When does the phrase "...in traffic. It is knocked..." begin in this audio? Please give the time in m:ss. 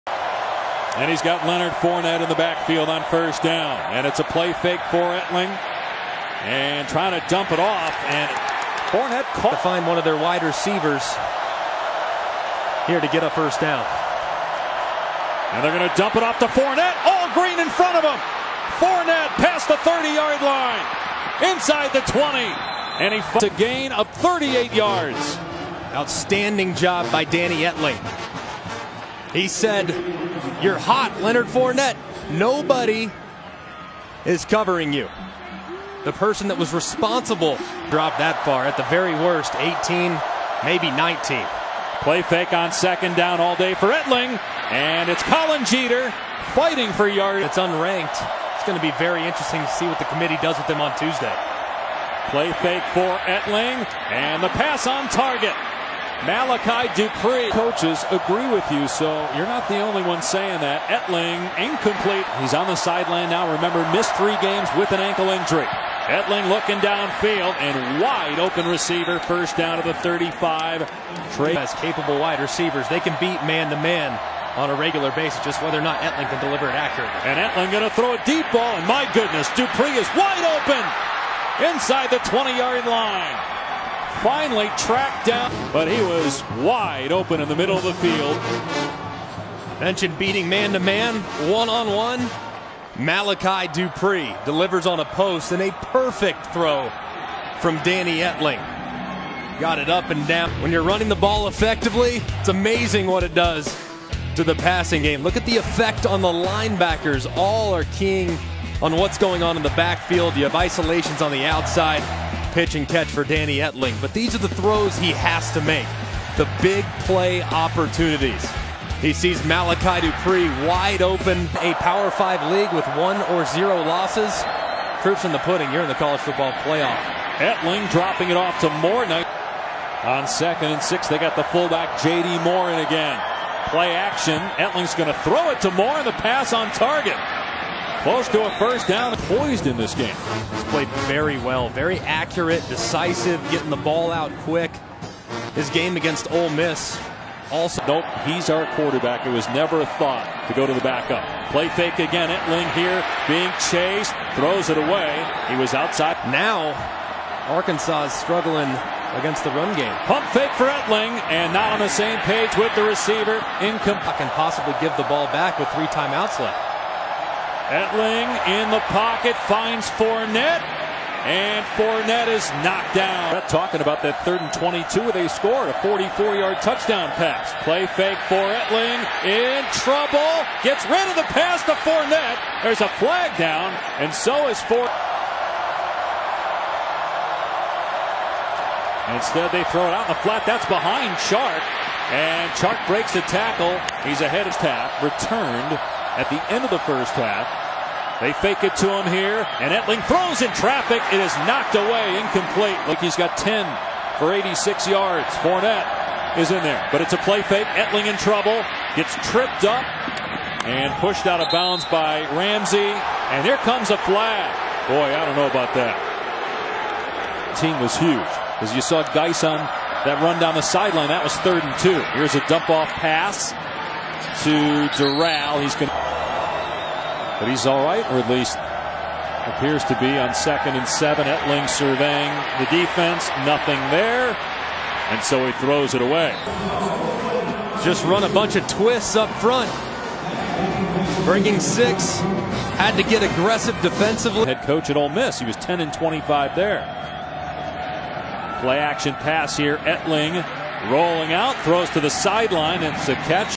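3:20.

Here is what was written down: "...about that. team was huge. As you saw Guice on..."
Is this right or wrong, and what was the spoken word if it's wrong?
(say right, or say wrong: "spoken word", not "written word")
right.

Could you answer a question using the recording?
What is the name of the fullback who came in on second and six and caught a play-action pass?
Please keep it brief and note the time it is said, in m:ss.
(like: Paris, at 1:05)
J.D. Moore, at 2:12.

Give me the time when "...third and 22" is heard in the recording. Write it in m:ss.
2:54.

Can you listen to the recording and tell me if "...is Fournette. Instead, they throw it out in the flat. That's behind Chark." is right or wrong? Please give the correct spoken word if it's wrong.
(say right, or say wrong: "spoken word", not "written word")
right.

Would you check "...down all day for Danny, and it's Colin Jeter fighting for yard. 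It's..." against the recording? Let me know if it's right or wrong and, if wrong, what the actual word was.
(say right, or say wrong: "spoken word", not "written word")
wrong: "Etling", not "Danny".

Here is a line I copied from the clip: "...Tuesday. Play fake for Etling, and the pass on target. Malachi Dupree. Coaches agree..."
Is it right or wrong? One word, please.
right.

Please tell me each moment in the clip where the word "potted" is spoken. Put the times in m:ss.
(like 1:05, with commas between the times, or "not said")
not said.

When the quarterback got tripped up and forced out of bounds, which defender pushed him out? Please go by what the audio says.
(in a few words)
Ramsey.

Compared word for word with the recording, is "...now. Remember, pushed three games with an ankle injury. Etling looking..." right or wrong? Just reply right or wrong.
wrong.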